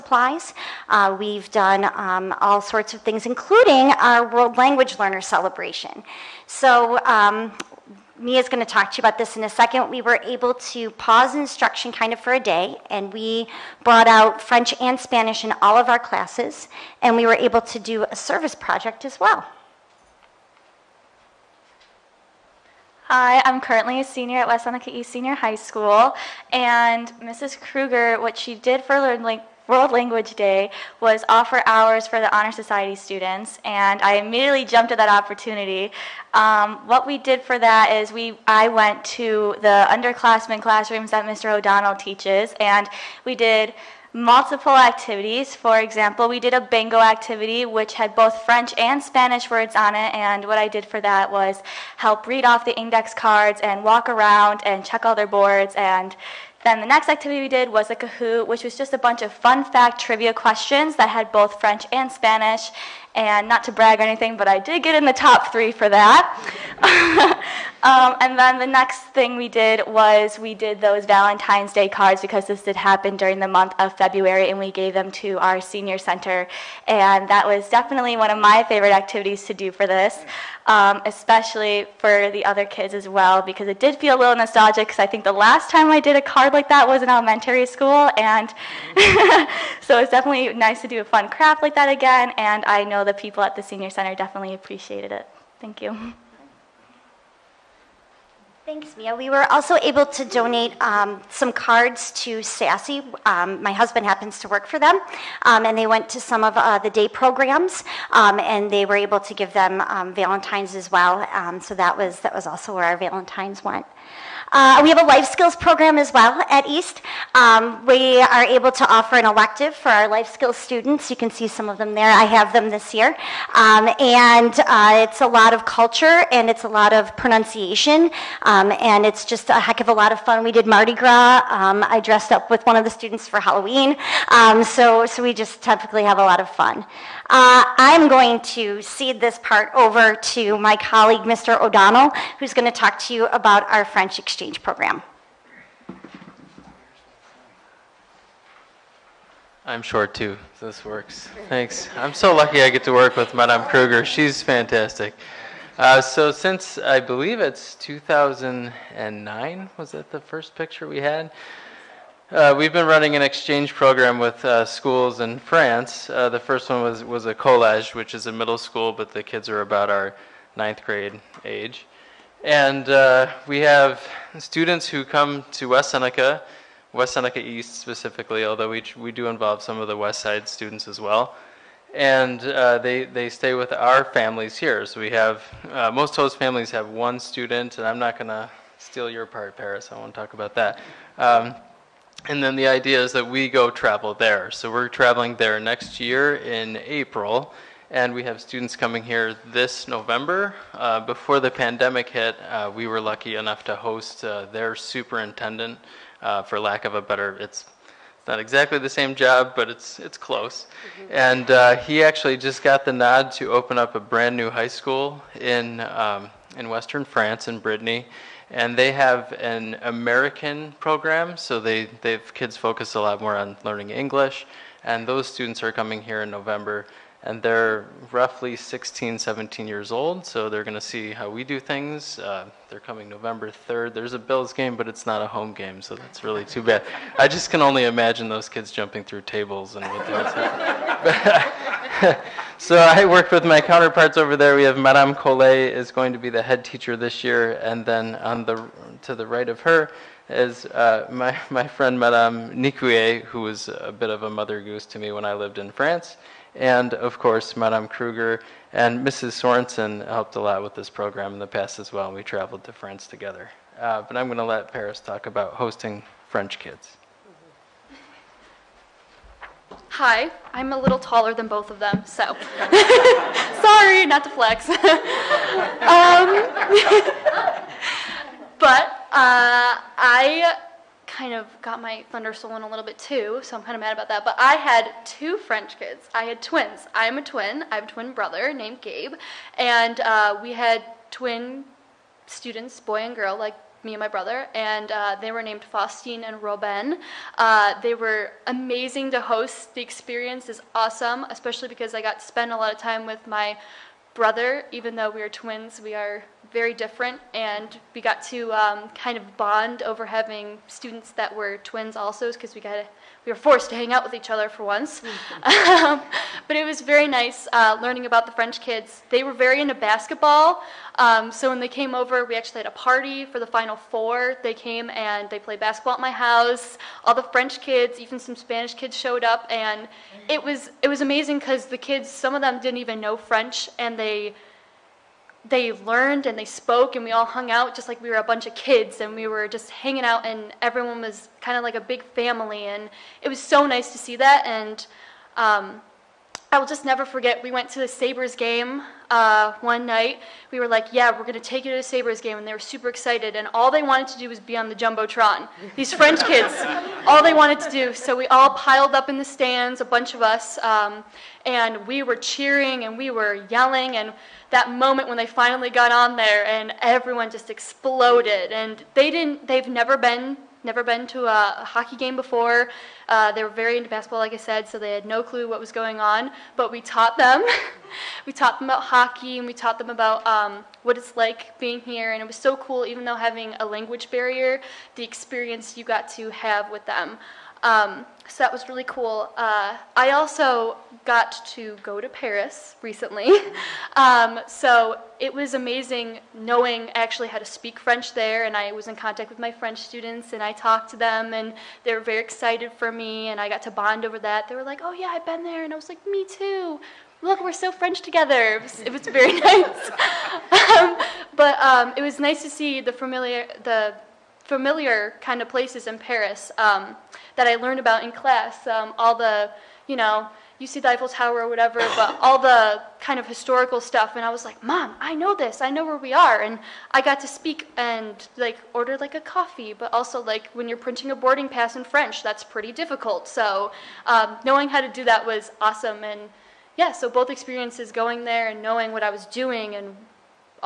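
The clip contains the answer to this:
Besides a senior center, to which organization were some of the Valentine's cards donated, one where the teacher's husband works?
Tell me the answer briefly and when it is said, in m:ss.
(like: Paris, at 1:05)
SASi, at 1:42.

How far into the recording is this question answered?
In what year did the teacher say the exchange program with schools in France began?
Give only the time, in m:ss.
2:37.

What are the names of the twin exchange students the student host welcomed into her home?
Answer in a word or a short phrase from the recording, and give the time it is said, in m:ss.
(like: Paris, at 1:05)
Faustine and Robin, at 4:55.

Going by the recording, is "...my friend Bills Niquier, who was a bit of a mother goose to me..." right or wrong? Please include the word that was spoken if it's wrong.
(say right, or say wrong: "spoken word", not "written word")
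wrong: "Madame", not "Bills".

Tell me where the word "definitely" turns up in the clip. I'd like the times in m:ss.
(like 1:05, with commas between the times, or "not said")
1:17, 1:30, 1:34.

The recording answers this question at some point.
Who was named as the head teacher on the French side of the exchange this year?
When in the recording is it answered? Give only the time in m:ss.
4:04.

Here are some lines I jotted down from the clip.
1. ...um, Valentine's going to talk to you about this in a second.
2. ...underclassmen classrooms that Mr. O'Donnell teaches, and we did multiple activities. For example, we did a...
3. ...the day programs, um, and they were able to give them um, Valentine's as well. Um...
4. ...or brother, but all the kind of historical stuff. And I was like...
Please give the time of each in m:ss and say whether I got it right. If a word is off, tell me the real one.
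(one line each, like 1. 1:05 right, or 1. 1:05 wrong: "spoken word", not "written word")
1. 0:07 wrong: "Mia", not "Valentine"
2. 0:39 right
3. 1:46 right
4. 7:01 wrong: "whatever", not "brother".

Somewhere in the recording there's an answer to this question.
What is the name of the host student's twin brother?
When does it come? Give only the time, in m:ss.
4:48.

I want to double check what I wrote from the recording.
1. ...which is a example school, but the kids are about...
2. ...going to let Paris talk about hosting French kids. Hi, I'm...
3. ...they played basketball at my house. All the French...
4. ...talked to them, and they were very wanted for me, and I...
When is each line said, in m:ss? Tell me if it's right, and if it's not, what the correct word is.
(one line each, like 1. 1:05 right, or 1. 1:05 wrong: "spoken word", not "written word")
1. 2:47 wrong: "middle", not "example"
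2. 4:24 right
3. 5:25 right
4. 6:40 wrong: "excited", not "wanted".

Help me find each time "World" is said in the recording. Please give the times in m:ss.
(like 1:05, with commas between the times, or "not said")
0:04, 0:29.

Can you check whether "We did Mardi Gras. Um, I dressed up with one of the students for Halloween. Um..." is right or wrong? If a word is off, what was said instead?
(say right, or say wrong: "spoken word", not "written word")
right.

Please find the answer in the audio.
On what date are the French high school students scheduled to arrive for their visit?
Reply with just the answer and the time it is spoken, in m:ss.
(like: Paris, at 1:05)
November 3rd, at 3:53.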